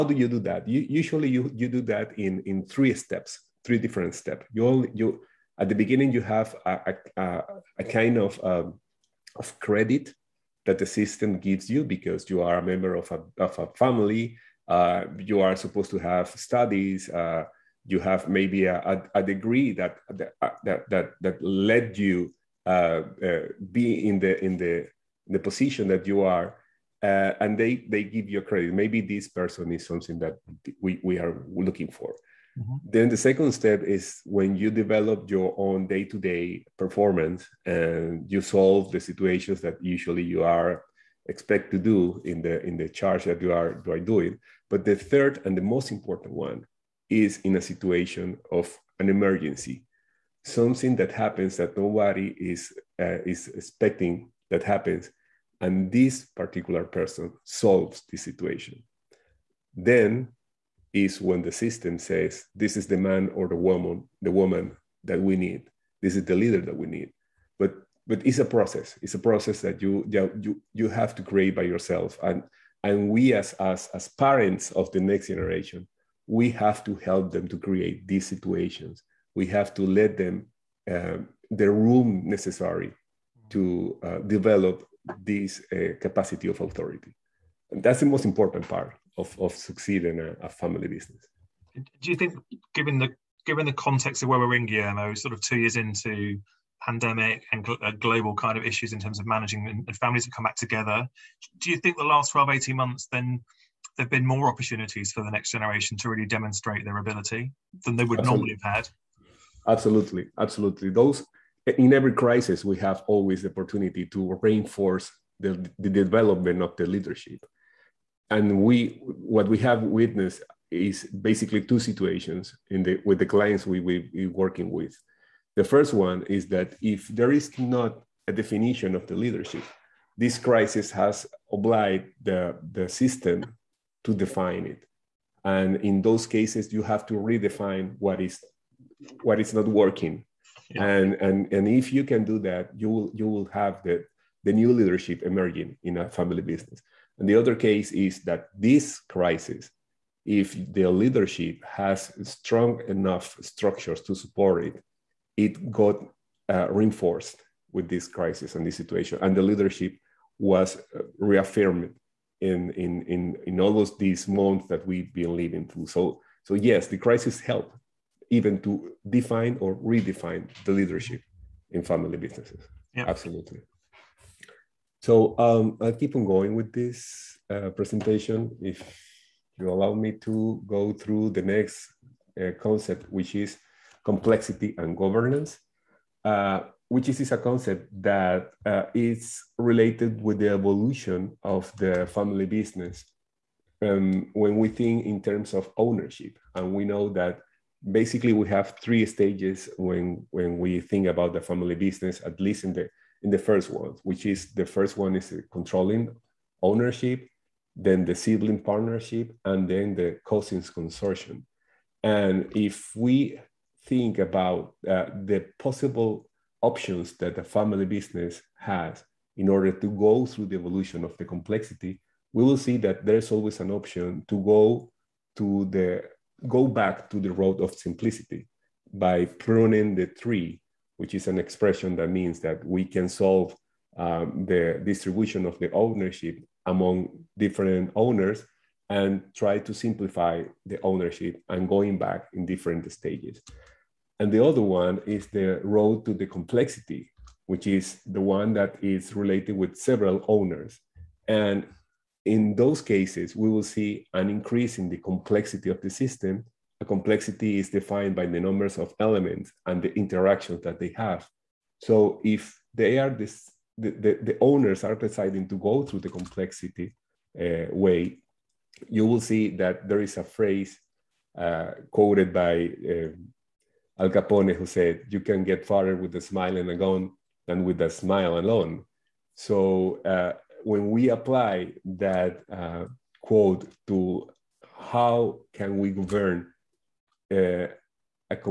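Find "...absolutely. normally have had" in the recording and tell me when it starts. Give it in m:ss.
1:48.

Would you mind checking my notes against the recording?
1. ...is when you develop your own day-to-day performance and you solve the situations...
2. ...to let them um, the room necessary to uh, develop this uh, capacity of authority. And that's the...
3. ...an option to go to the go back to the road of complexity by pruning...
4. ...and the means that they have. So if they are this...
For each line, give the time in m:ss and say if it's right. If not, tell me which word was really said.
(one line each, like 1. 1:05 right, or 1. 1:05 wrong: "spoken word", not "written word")
1. 0:33 right
2. 1:19 right
3. 3:43 wrong: "simplicity", not "complexity"
4. 4:19 wrong: "interactions", not "means".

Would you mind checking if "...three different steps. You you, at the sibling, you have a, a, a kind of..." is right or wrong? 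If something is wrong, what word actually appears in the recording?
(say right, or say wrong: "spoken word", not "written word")
wrong: "beginning", not "sibling".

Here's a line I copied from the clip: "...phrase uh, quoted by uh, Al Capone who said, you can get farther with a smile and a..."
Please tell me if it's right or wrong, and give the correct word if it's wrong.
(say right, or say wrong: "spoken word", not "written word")
right.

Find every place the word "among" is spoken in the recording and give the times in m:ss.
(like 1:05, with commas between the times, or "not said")
3:56.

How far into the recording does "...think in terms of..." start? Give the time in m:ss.
3:14.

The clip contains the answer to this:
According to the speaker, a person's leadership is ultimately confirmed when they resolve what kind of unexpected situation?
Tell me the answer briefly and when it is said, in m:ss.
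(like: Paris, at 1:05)
an emergency, at 0:48.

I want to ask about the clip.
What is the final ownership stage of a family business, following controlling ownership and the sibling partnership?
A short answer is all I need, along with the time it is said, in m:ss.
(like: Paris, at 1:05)
cousins consortium, at 3:30.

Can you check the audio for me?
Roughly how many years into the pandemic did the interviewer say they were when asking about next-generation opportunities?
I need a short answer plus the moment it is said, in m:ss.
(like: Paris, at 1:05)
2, at 1:35.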